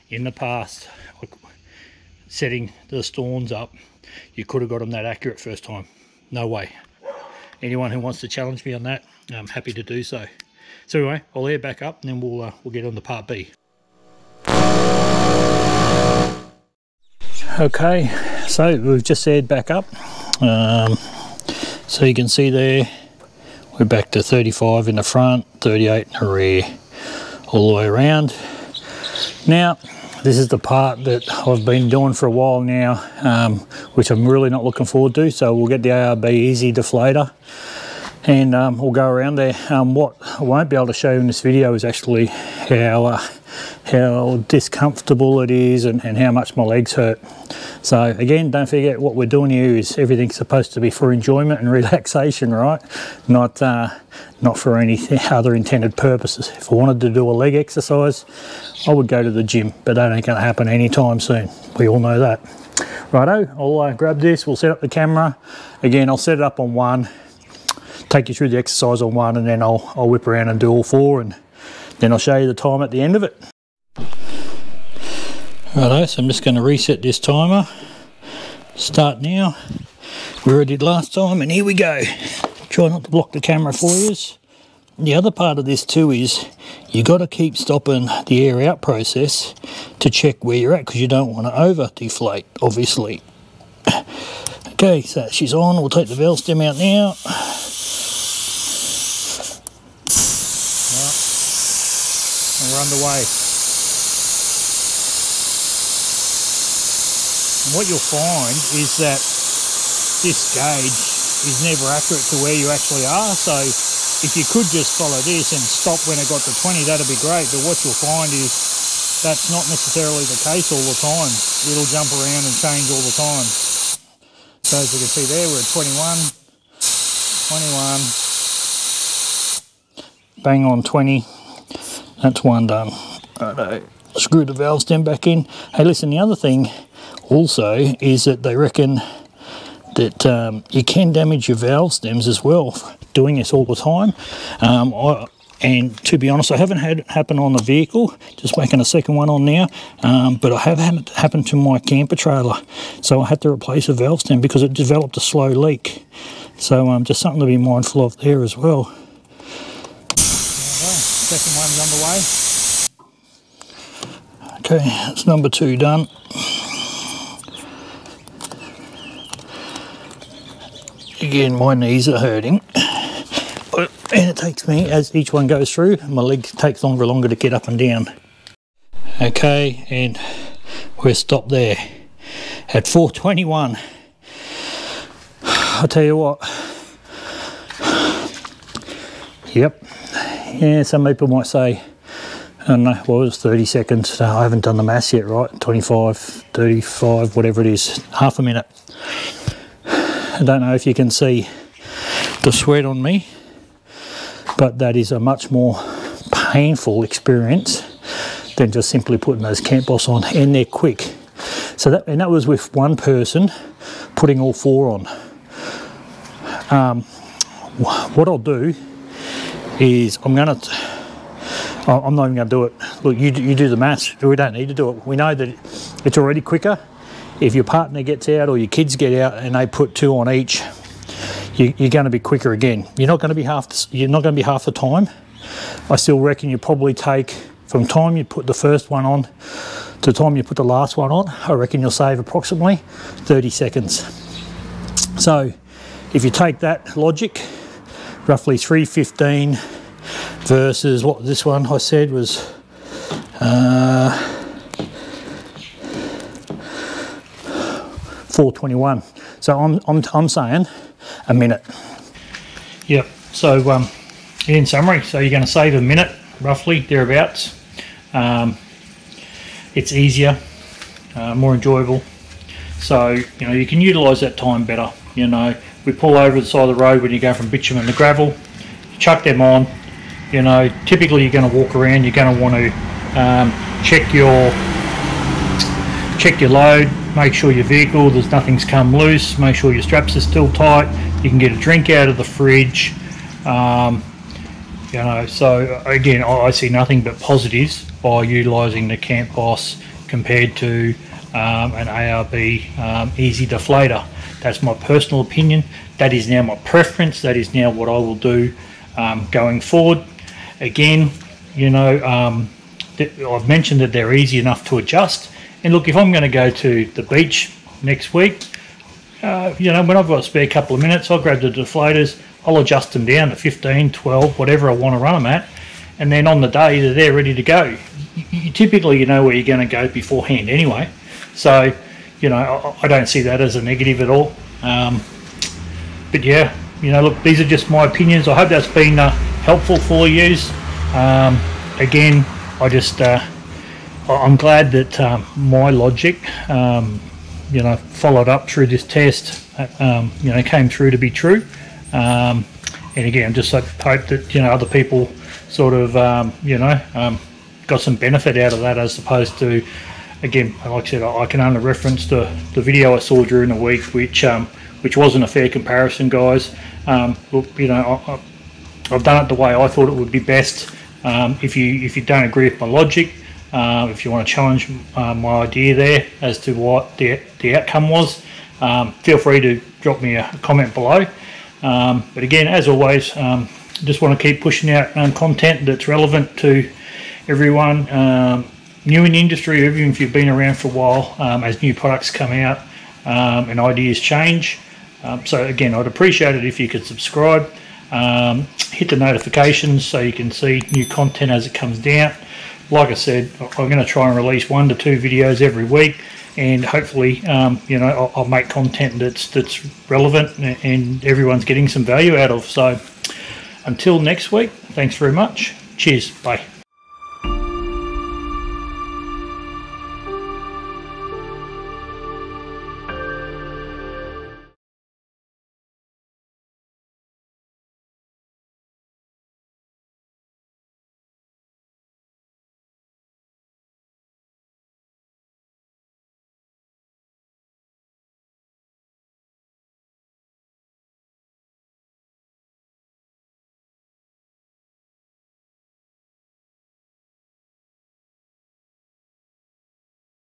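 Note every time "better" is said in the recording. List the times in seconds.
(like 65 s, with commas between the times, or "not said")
274 s.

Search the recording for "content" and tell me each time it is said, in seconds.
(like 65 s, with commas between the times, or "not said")
385 s, 400 s, 408 s.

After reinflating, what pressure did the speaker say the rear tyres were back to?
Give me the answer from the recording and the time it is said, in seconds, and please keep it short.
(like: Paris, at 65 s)
38, at 25 s.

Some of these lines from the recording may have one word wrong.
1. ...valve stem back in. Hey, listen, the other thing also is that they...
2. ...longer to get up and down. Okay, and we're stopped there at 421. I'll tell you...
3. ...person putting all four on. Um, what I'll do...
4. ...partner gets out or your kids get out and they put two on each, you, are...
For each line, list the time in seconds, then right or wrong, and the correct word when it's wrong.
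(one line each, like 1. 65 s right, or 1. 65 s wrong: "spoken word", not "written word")
1. 134 s right
2. 177 s right
3. 212 s right
4. 227 s right.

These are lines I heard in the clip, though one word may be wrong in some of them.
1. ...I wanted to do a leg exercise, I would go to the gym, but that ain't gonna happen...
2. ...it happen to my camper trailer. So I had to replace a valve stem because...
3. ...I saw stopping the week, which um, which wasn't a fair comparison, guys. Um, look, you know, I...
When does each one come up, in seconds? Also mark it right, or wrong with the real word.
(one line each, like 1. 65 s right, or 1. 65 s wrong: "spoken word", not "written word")
1. 56 s right
2. 150 s right
3. 362 s wrong: "during", not "stopping".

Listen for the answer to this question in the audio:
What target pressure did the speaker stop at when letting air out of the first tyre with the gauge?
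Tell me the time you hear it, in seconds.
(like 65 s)
130 s.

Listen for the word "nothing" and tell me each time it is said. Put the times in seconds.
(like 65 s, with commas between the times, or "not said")
288 s, 296 s.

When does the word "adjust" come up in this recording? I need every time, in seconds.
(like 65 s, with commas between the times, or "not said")
314 s, 322 s.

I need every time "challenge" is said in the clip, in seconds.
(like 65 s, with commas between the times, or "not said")
8 s, 374 s.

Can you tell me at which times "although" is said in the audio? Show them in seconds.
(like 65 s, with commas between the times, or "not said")
not said.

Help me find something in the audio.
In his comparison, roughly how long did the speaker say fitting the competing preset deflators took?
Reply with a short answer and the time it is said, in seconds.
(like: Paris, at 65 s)
3:15, at 248 s.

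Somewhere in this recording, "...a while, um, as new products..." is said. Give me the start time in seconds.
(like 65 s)
390 s.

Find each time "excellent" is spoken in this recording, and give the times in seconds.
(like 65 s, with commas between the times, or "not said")
not said.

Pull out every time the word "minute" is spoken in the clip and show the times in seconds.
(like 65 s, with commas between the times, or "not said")
198 s, 261 s, 265 s, 320 s.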